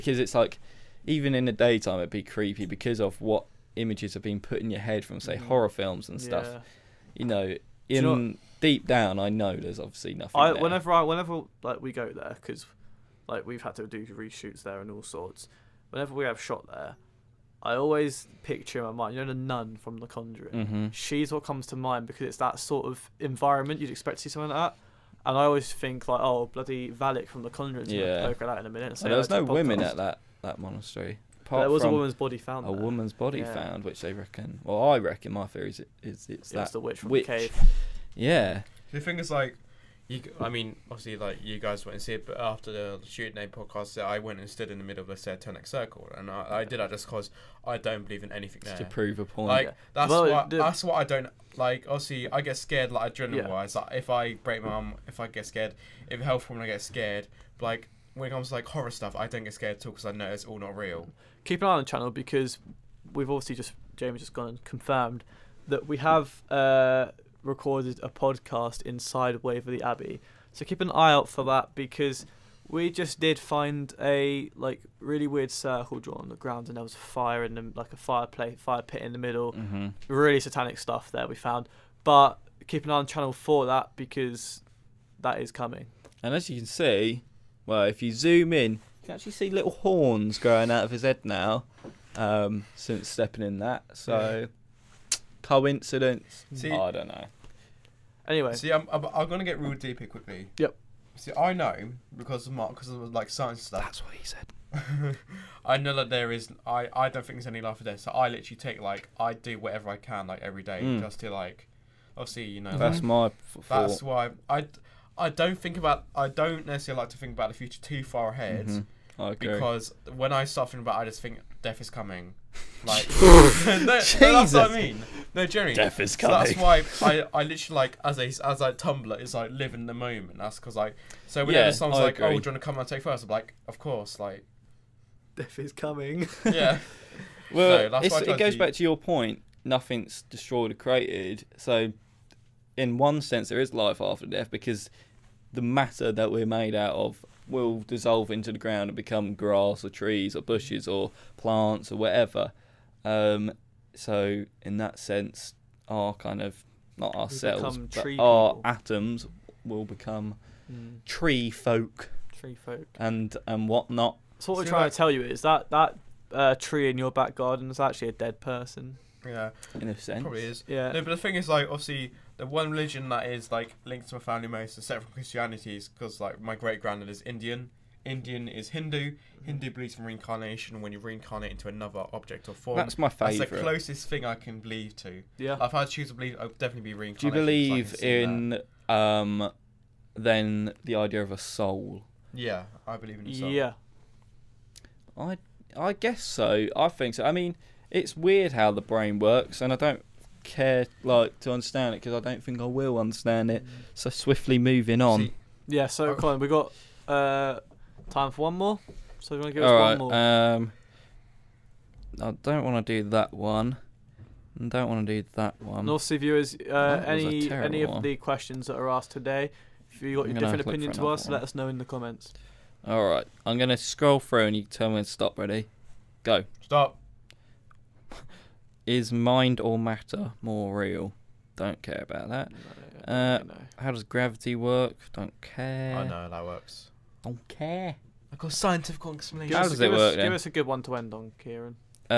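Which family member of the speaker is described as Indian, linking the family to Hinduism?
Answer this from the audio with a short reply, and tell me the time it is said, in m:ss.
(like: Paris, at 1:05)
great granddad, at 2:56.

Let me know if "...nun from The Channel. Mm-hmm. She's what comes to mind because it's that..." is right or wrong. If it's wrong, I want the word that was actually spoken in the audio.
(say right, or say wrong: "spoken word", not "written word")
wrong: "Conjuring", not "Channel".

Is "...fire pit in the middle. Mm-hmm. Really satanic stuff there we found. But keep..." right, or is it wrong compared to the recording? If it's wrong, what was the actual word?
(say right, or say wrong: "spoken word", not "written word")
right.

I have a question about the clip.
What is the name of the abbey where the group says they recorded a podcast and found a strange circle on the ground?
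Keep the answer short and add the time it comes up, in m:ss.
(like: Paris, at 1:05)
Waverley Abbey, at 1:09.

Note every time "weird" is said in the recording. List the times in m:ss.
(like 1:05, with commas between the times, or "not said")
1:15, 3:18.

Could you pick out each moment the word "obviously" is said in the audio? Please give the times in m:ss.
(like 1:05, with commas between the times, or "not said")
0:09, 0:40, 0:51, 1:03, 1:52, 2:51.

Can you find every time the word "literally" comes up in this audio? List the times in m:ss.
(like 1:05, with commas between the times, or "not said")
1:48, 2:07.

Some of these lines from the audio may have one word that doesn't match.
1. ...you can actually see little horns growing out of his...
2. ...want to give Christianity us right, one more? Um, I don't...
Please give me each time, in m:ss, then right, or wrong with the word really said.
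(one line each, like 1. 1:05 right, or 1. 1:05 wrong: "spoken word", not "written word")
1. 1:28 right
2. 3:29 wrong: "All", not "Christianity".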